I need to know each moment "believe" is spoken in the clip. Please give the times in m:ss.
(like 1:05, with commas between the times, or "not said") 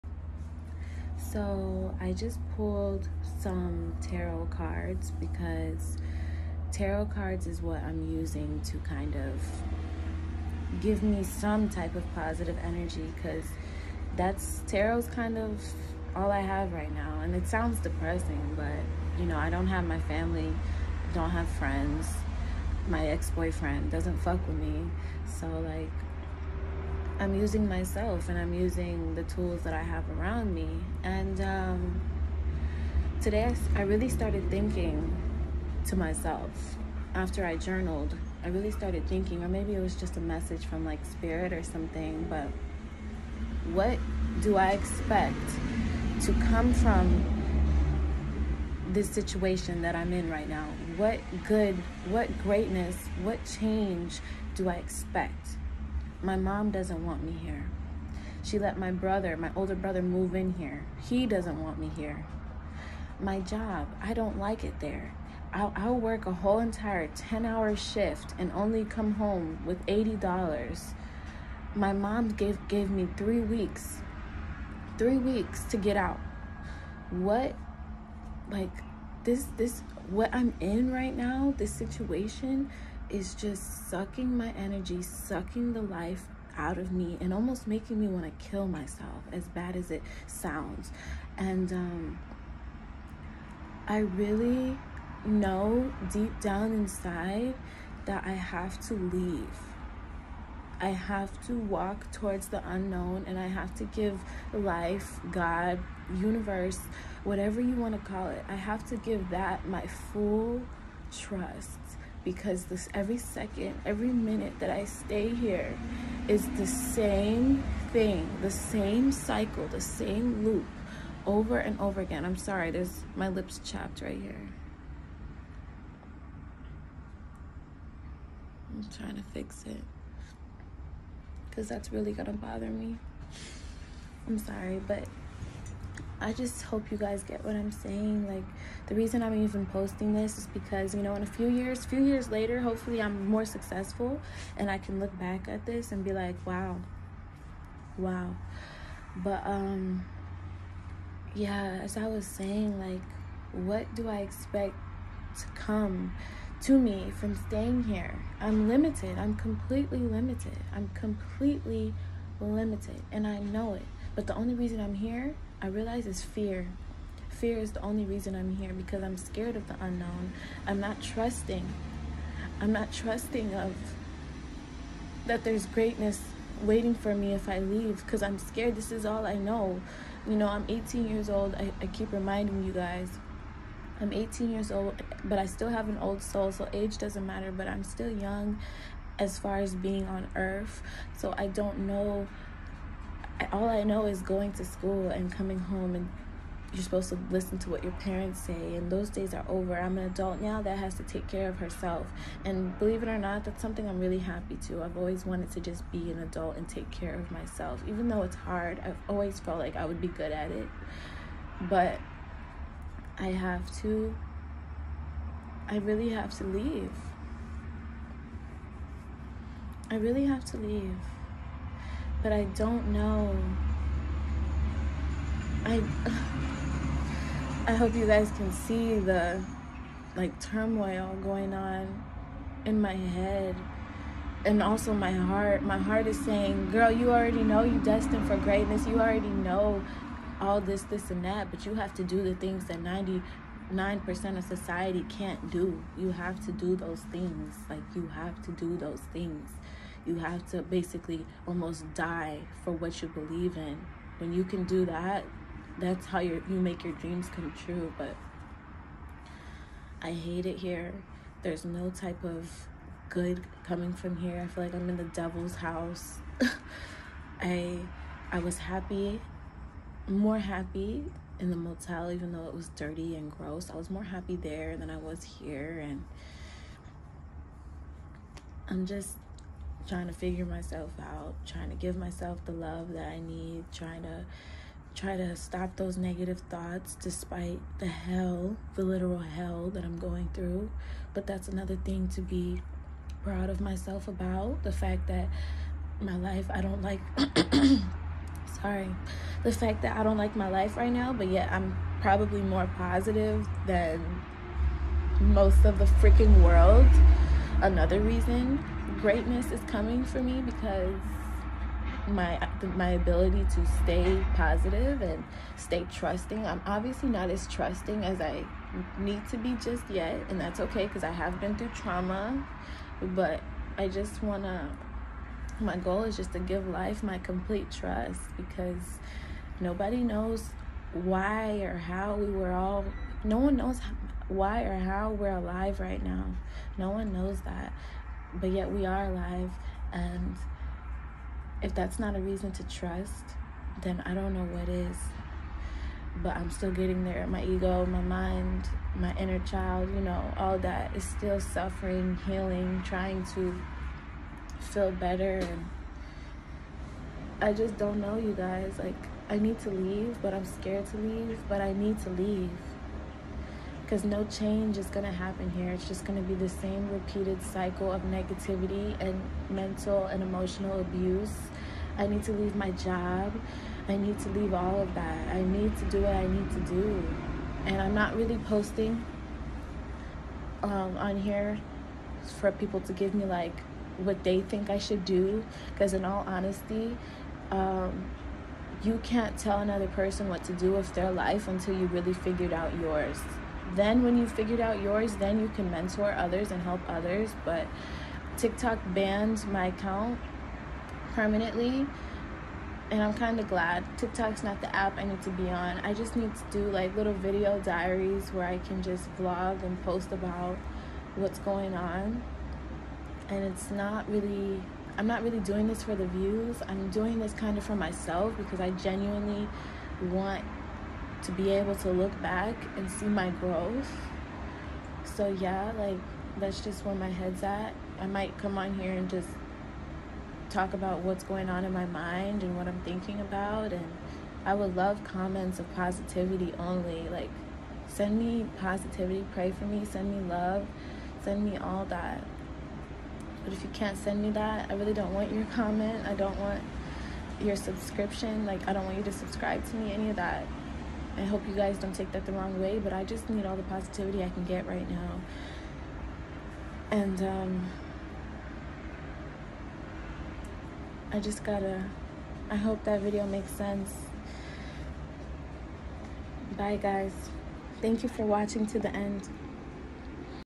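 3:22, 4:13.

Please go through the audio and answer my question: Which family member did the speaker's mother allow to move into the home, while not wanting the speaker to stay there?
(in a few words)
older brother.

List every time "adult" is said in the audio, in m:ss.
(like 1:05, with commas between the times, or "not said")
3:20, 3:26.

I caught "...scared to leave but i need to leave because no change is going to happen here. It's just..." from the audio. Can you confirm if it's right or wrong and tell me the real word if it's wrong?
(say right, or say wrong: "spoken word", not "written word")
right.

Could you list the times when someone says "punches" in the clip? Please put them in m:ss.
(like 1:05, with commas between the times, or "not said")
not said.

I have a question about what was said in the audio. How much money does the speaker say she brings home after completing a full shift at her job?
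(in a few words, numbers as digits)
$80.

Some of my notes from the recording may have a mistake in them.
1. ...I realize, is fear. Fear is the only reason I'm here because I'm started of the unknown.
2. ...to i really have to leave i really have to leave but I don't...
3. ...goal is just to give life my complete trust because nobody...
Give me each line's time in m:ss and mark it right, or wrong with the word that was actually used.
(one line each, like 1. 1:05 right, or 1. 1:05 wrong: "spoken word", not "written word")
1. 2:45 wrong: "scared", not "started"
2. 3:33 right
3. 5:25 right.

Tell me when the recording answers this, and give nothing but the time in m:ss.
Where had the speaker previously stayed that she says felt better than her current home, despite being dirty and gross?
4:31.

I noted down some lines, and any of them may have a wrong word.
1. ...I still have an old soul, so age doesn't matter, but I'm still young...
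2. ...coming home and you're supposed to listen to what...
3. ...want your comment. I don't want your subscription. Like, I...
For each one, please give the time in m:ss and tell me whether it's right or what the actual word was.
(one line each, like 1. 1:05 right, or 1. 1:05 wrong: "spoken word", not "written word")
1. 3:05 right
2. 3:15 right
3. 7:25 right.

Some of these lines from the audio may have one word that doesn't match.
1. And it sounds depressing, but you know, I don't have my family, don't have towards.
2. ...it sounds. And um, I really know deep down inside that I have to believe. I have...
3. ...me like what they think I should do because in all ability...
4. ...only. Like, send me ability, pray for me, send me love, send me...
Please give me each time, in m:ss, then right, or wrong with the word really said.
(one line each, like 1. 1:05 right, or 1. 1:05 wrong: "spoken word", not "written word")
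1. 0:17 wrong: "friends", not "towards"
2. 1:29 wrong: "leave", not "believe"
3. 6:23 wrong: "honesty", not "ability"
4. 7:16 wrong: "positivity", not "ability".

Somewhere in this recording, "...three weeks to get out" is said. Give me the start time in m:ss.
1:14.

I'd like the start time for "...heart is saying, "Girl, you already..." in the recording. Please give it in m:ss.
3:55.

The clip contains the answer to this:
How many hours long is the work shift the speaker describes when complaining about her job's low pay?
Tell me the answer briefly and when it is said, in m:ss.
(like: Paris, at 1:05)
10, at 1:07.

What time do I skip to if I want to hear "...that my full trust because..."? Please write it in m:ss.
1:49.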